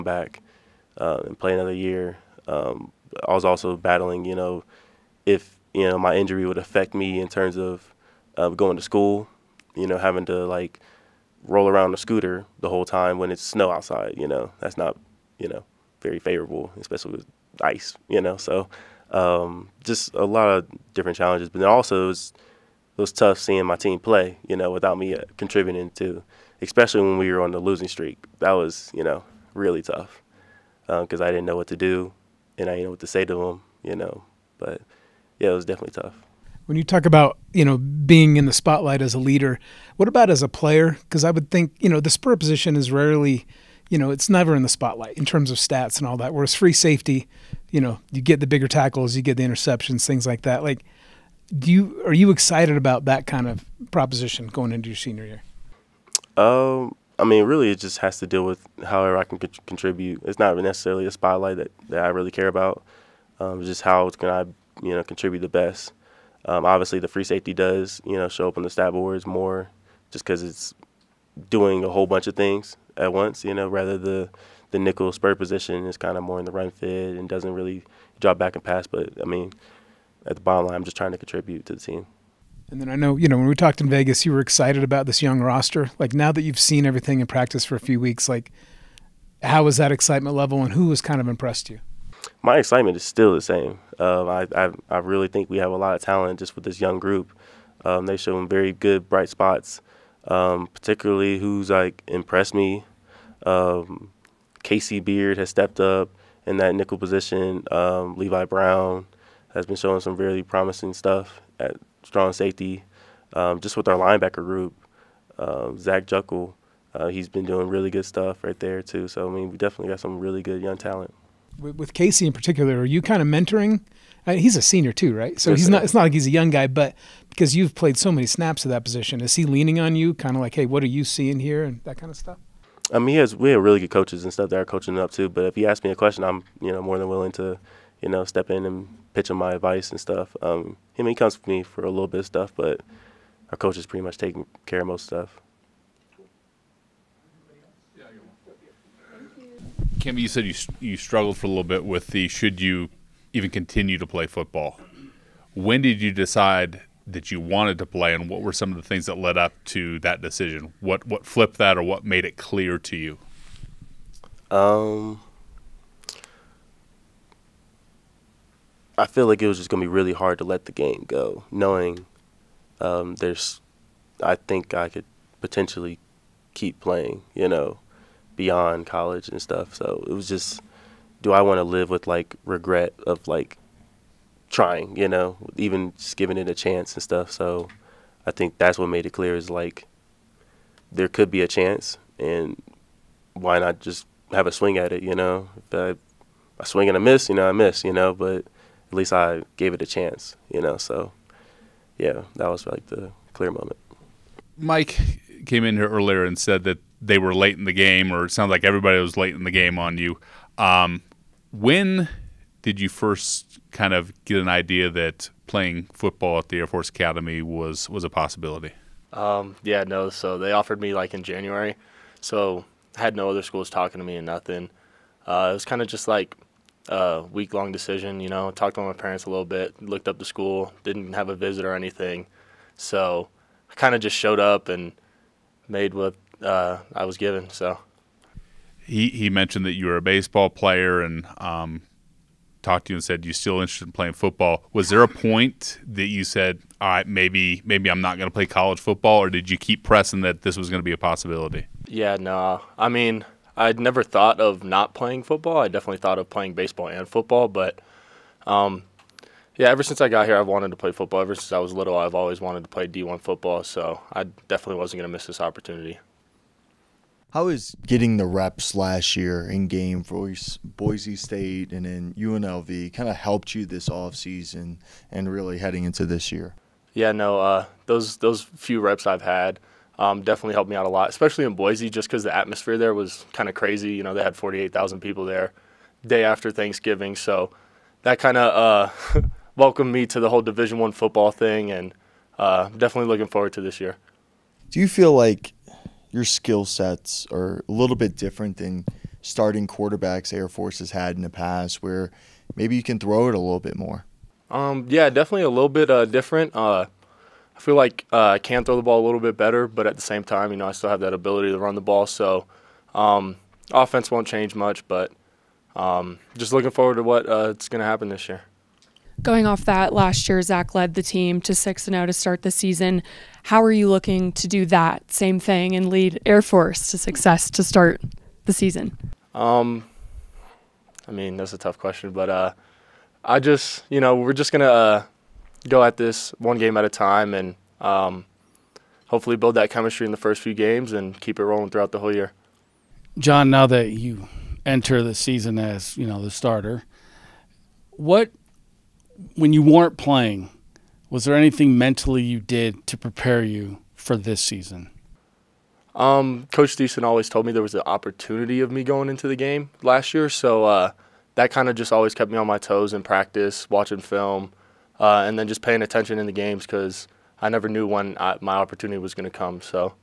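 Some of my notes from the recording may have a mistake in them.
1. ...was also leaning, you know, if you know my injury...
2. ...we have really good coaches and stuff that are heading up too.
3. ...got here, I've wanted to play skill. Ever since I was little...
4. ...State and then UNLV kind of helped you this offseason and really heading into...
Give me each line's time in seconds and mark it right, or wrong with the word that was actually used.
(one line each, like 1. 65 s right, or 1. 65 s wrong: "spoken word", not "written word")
1. 3 s wrong: "battling", not "leaning"
2. 133 s wrong: "coaching", not "heading"
3. 260 s wrong: "football", not "skill"
4. 271 s right.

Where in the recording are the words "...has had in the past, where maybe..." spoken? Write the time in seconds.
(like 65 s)
300 s.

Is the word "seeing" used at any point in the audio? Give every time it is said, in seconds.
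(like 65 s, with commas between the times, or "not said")
23 s, 131 s.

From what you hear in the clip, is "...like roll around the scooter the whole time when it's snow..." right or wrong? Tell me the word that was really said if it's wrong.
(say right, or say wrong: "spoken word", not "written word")
right.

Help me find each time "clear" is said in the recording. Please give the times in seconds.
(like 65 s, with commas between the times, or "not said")
162 s, 189 s, 203 s.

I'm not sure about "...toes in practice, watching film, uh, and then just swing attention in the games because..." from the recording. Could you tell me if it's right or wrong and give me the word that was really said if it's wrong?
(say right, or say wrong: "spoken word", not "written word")
wrong: "paying", not "swing".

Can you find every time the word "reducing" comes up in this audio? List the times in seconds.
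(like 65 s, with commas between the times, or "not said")
not said.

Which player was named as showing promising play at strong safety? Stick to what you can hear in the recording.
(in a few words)
Levi Brown.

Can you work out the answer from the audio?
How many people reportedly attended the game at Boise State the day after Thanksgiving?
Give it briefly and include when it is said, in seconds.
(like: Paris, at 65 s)
48,000, at 284 s.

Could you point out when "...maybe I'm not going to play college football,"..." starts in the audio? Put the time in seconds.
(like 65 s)
247 s.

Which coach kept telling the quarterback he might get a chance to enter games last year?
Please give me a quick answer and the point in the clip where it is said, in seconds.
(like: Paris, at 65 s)
Coach Thiessen, at 356 s.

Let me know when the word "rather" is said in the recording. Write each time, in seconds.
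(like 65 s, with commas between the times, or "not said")
73 s.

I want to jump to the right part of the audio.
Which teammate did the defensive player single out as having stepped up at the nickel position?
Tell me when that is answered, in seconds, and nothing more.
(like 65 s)
104 s.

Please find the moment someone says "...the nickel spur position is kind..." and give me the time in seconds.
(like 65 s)
74 s.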